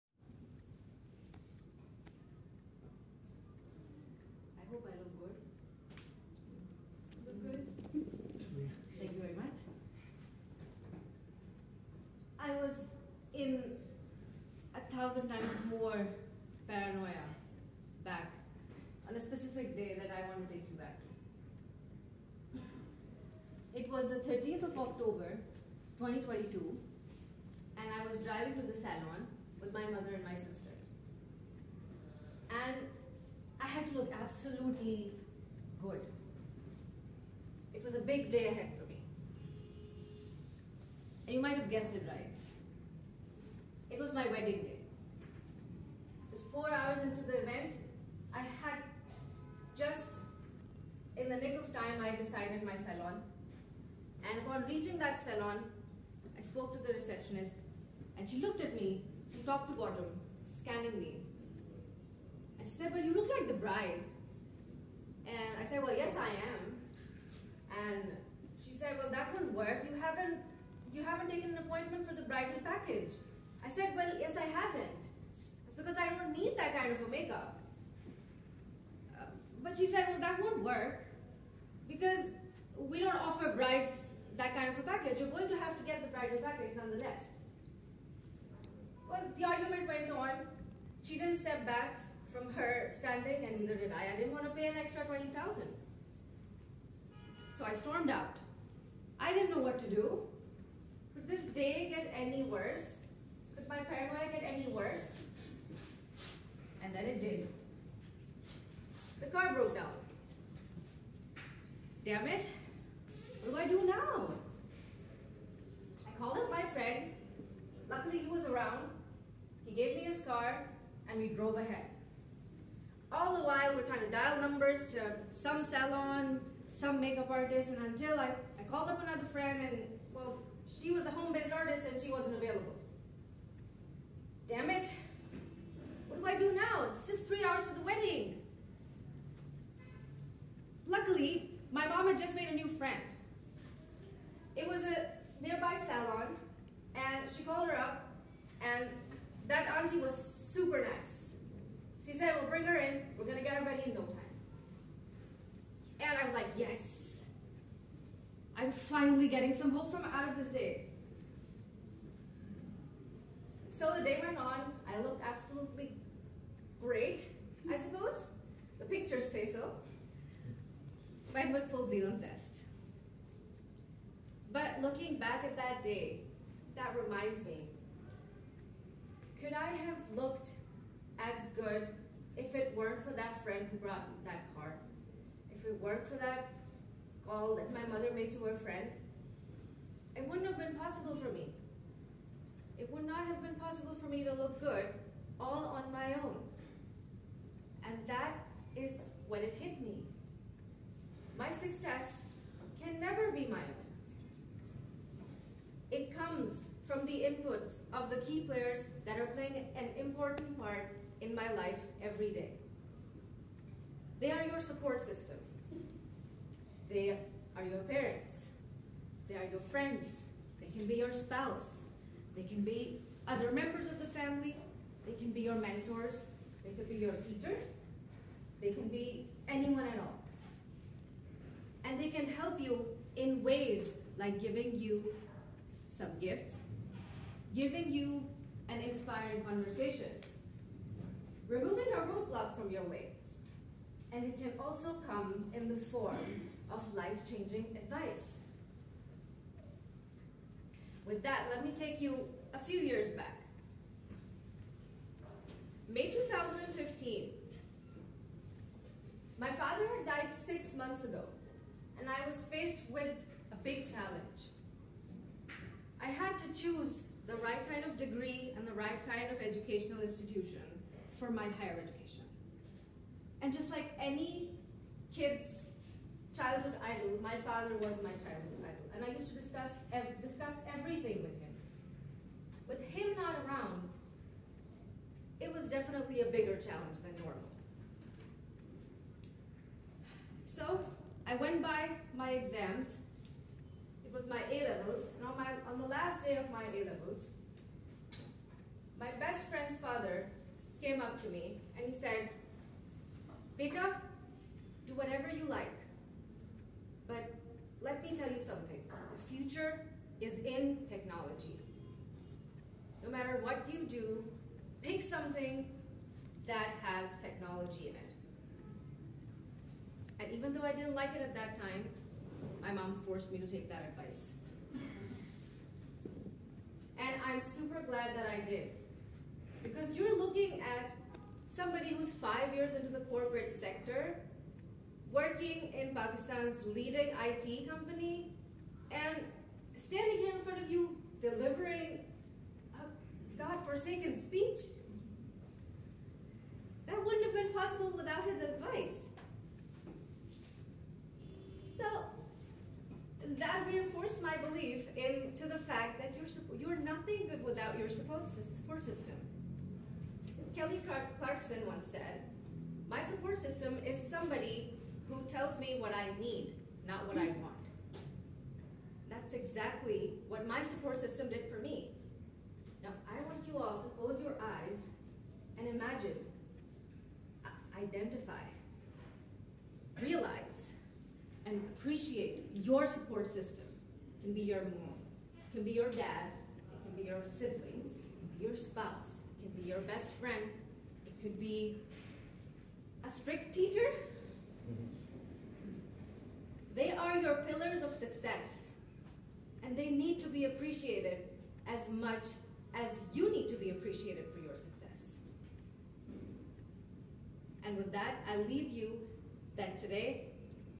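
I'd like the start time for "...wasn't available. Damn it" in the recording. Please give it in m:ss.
2:12.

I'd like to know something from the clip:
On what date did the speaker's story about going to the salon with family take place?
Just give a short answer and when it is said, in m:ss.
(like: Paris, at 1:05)
13 October 2022, at 0:24.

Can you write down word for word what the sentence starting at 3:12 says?
It would not have been possible for me to look good all on my own.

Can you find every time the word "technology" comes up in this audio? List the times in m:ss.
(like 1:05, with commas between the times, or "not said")
5:10, 5:17.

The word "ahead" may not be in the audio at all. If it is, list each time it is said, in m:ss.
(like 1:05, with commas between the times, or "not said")
0:38, 2:01.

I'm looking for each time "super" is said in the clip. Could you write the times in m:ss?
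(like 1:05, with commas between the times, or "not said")
2:30, 5:27.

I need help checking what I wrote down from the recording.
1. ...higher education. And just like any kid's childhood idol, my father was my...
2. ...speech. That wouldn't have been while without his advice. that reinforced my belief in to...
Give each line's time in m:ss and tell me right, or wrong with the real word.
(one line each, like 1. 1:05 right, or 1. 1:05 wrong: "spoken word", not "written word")
1. 4:31 right
2. 5:44 wrong: "possible", not "while".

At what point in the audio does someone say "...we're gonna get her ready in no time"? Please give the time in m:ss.
2:33.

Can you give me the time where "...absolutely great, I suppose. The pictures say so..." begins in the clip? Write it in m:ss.
2:45.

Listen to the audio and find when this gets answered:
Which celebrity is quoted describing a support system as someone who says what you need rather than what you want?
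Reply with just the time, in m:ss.
6:00.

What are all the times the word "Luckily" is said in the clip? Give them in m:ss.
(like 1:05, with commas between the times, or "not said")
1:57, 2:20.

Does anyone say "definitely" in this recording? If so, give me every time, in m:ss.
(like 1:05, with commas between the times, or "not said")
4:45.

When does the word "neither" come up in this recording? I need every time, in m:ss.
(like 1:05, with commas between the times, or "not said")
1:33.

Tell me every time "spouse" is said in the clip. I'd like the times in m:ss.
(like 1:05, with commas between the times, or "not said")
3:41, 6:28.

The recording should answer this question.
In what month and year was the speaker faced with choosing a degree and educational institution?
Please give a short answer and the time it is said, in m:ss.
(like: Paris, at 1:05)
May 2015, at 4:15.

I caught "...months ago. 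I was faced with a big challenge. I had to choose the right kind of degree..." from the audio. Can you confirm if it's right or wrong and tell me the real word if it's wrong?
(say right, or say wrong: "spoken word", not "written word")
right.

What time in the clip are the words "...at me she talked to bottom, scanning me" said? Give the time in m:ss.
0:58.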